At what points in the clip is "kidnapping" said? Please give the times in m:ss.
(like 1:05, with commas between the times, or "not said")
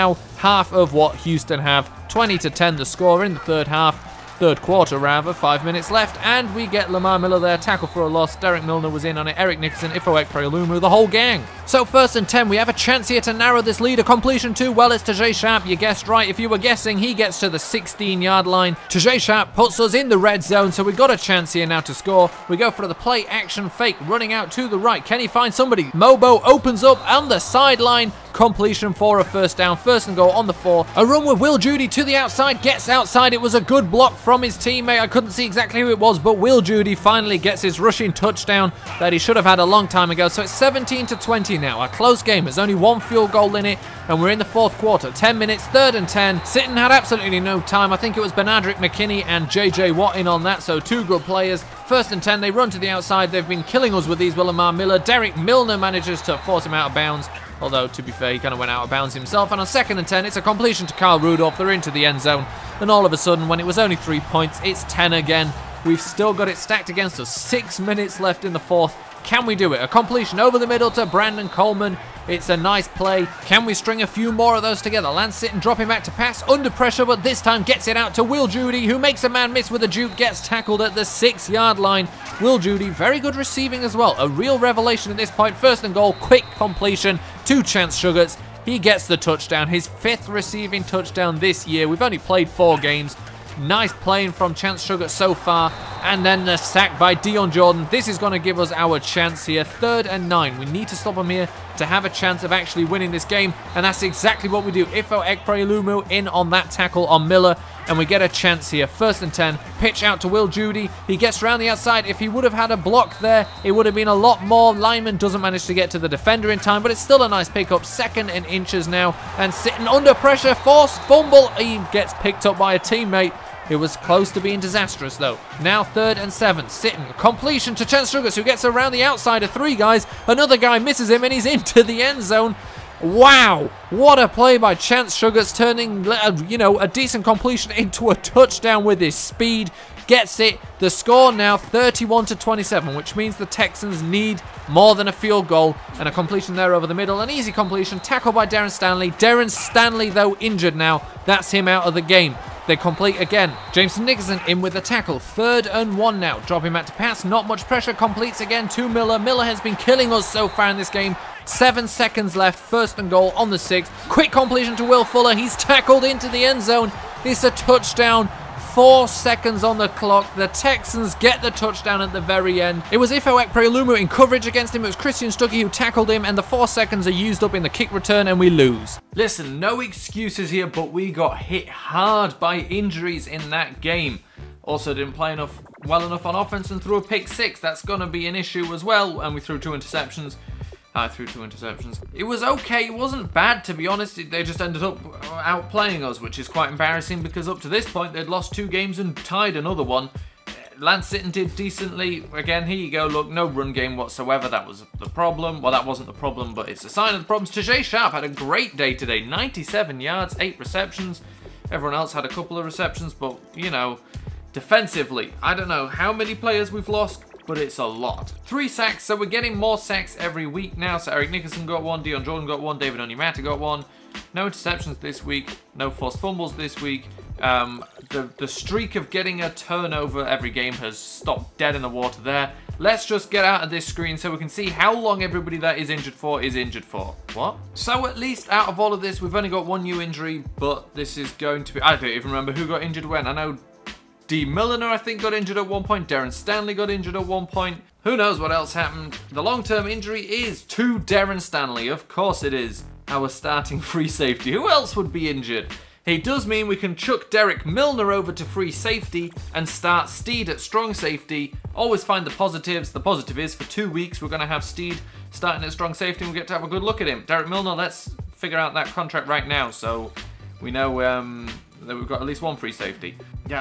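not said.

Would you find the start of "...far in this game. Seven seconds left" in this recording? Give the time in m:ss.
2:40.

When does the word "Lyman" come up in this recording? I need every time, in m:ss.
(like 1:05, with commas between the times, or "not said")
1:54.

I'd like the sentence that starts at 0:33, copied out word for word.
It was a good block from his teammate.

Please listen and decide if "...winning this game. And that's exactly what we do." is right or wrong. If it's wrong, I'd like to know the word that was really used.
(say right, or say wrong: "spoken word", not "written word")
right.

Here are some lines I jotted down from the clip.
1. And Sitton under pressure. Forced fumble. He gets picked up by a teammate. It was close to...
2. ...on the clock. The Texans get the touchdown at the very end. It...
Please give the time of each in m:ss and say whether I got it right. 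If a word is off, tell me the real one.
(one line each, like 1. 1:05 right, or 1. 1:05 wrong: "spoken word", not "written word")
1. 1:59 right
2. 2:49 right.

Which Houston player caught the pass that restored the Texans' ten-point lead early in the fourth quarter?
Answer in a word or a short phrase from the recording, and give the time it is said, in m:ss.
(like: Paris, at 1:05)
Carl Rudolph, at 1:00.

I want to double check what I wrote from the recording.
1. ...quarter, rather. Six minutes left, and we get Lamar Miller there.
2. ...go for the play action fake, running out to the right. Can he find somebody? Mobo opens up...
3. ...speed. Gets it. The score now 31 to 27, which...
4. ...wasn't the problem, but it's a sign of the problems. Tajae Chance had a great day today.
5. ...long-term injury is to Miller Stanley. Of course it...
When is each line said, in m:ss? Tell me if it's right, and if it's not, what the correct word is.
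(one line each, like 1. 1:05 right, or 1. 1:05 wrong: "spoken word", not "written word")
1. 0:04 wrong: "Five", not "Six"
2. 0:22 right
3. 2:19 right
4. 3:25 wrong: "Sharpe", not "Chance"
5. 4:09 wrong: "Darren", not "Miller".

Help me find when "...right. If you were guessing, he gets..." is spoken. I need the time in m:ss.
0:16.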